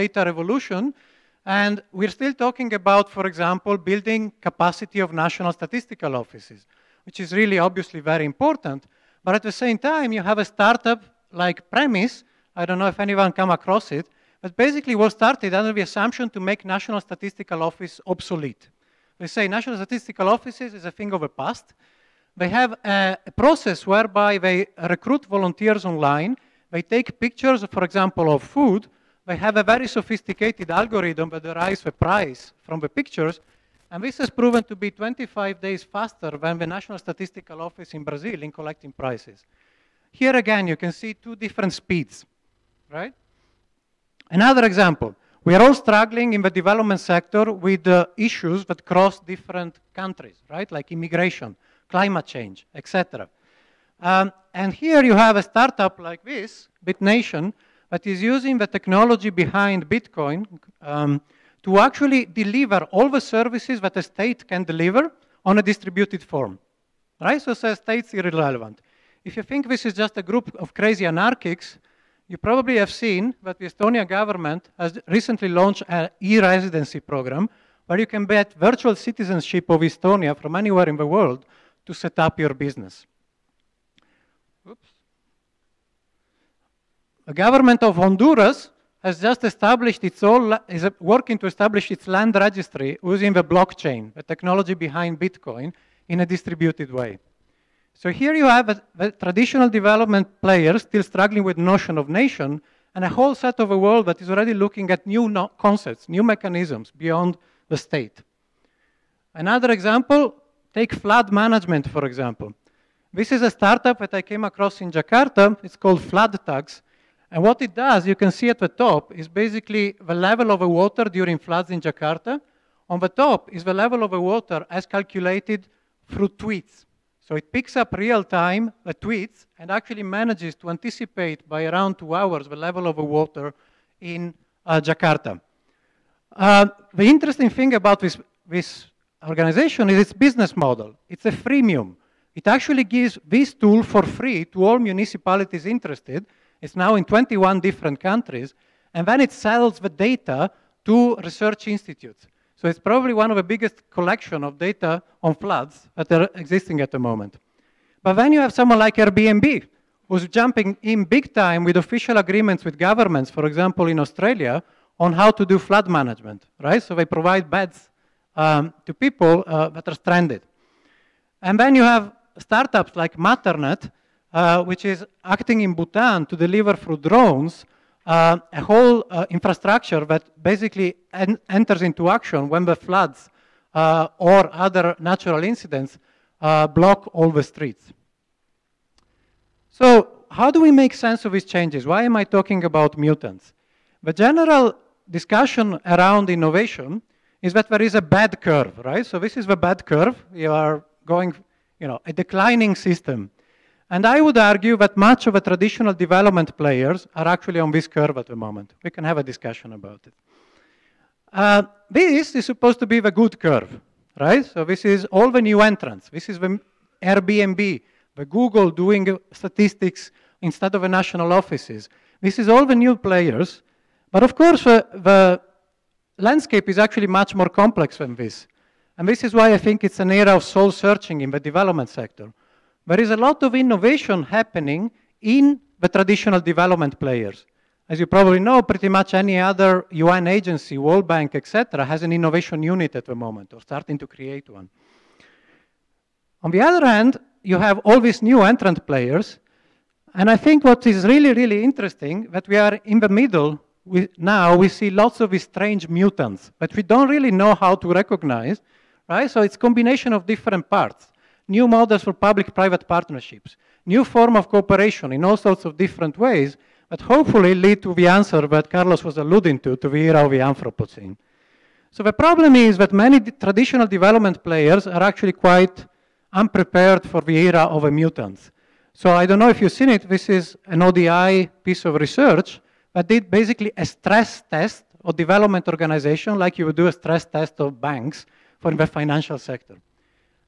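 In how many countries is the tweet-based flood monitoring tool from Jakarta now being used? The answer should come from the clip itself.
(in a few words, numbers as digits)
21.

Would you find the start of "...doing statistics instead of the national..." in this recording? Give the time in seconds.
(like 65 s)
218 s.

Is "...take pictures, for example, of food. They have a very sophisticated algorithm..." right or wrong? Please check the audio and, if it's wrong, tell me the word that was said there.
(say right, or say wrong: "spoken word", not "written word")
right.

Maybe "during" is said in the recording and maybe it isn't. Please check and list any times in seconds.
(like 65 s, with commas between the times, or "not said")
121 s.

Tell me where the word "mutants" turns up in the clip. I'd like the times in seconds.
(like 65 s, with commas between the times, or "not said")
192 s, 255 s, 277 s.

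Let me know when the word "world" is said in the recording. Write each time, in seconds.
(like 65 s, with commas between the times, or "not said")
81 s, 103 s, 240 s.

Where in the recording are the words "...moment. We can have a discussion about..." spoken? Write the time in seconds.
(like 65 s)
208 s.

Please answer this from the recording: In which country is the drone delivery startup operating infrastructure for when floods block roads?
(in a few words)
Bhutan.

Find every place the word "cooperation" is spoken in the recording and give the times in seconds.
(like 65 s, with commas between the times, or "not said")
264 s.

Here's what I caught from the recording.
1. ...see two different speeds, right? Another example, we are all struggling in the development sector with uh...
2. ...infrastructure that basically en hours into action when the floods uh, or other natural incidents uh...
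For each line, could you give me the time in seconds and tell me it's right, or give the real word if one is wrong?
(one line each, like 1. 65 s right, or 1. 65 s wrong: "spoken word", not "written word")
1. 40 s right
2. 179 s wrong: "enters", not "hours".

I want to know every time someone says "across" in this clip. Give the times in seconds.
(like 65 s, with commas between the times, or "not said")
13 s, 114 s.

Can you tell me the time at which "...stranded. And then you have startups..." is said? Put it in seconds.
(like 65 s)
169 s.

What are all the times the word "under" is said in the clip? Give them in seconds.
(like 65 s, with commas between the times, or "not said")
15 s.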